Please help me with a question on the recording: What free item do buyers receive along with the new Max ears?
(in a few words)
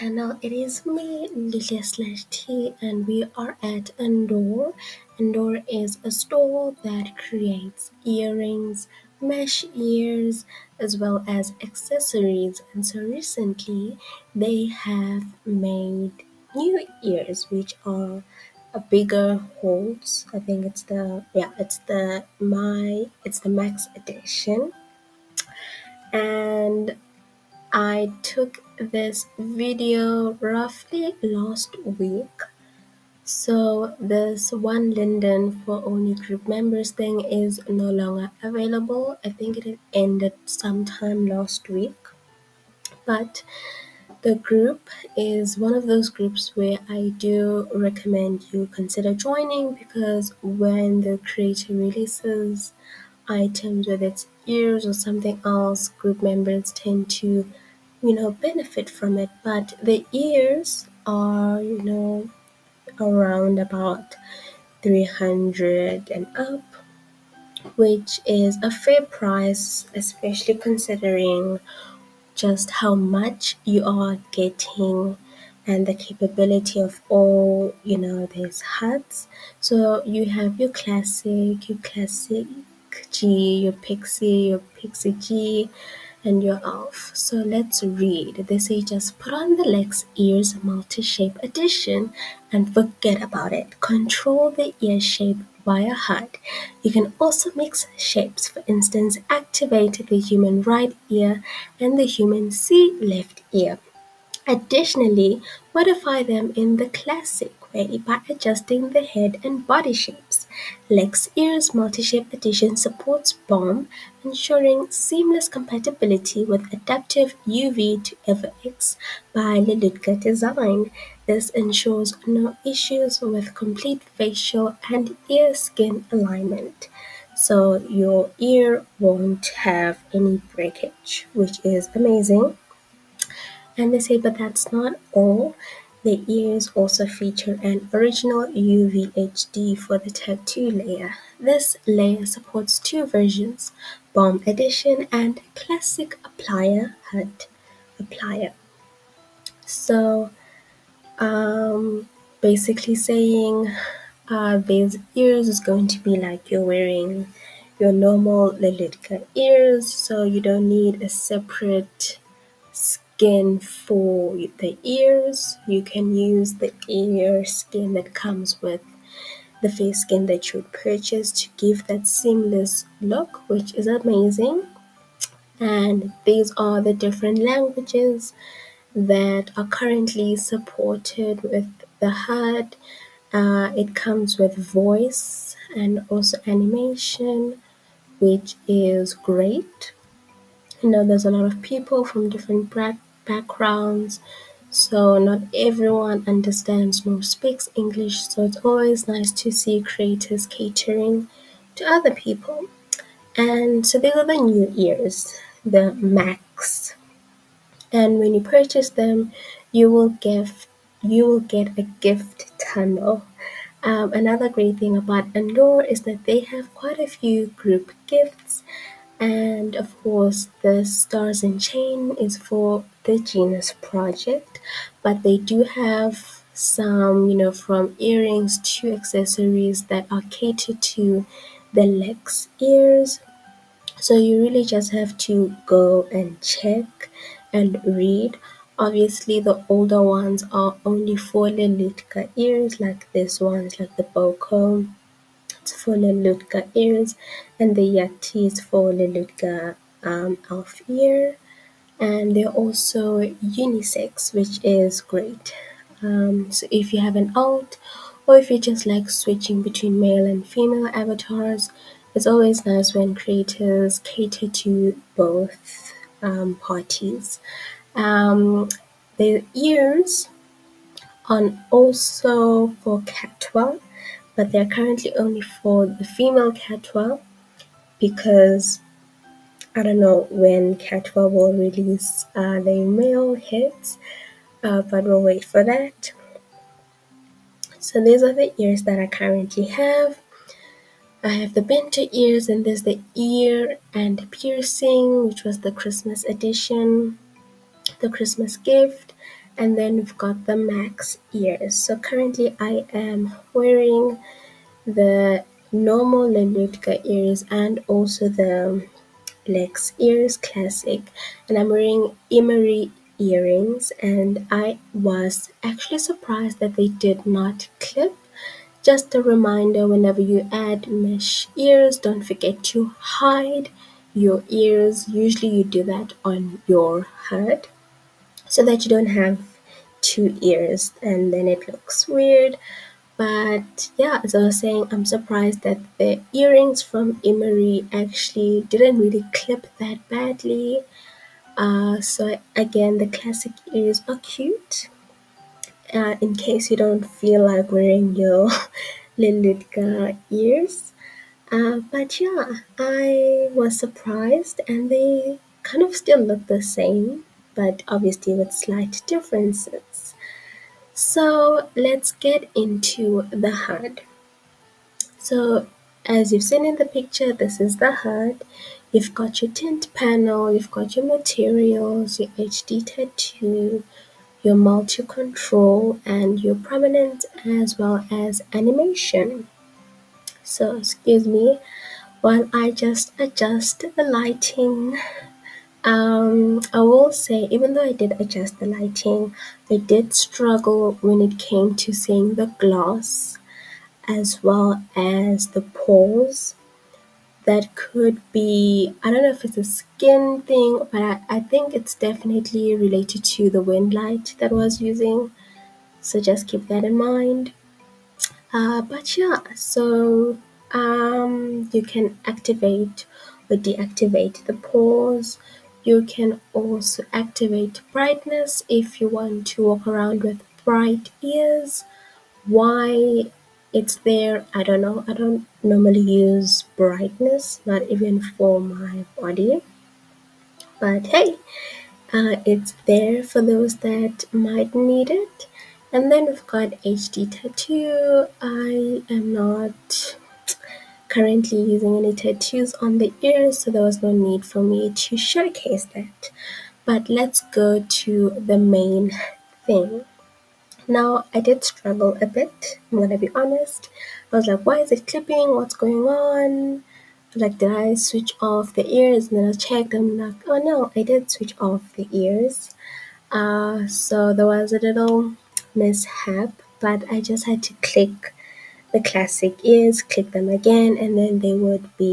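A gift tunnel.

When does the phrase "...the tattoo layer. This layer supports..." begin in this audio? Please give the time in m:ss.
2:19.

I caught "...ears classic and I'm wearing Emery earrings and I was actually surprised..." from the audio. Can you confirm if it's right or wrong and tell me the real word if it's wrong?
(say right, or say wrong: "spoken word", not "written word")
right.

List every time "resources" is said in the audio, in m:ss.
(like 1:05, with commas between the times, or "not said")
not said.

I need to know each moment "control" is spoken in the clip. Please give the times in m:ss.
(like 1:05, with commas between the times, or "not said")
1:33, 6:14.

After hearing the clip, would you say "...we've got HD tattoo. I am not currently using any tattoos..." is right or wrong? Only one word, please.
right.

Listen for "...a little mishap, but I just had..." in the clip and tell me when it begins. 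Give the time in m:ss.
7:44.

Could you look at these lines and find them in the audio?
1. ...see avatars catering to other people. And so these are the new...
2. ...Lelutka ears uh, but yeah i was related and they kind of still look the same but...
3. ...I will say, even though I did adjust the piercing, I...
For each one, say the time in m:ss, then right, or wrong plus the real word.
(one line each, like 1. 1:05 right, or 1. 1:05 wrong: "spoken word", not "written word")
1. 3:19 wrong: "creators", not "avatars"
2. 5:49 wrong: "surprised", not "related"
3. 6:26 wrong: "lighting", not "piercing".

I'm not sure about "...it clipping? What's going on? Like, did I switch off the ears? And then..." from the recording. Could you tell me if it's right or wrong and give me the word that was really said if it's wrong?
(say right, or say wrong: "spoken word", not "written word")
right.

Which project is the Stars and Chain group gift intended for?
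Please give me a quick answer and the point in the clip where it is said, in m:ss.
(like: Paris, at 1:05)
Genus Project, at 3:43.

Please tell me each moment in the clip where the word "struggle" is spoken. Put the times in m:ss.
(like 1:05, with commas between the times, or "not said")
6:30, 7:31.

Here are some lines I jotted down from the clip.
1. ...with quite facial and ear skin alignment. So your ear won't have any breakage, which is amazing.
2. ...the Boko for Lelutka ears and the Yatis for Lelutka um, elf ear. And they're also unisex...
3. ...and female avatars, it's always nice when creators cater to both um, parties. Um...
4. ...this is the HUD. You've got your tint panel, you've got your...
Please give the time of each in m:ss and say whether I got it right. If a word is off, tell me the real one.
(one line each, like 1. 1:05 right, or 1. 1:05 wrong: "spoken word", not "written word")
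1. 2:03 wrong: "complete", not "quite"
2. 4:03 right
3. 4:20 right
4. 6:07 right.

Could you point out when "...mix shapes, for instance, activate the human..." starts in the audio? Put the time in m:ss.
1:37.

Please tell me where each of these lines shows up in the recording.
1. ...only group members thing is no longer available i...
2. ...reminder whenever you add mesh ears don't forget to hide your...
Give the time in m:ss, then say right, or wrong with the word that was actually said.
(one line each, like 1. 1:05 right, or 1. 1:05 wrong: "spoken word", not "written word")
1. 0:35 right
2. 5:19 right.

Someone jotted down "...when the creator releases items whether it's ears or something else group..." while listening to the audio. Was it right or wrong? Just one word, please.
right.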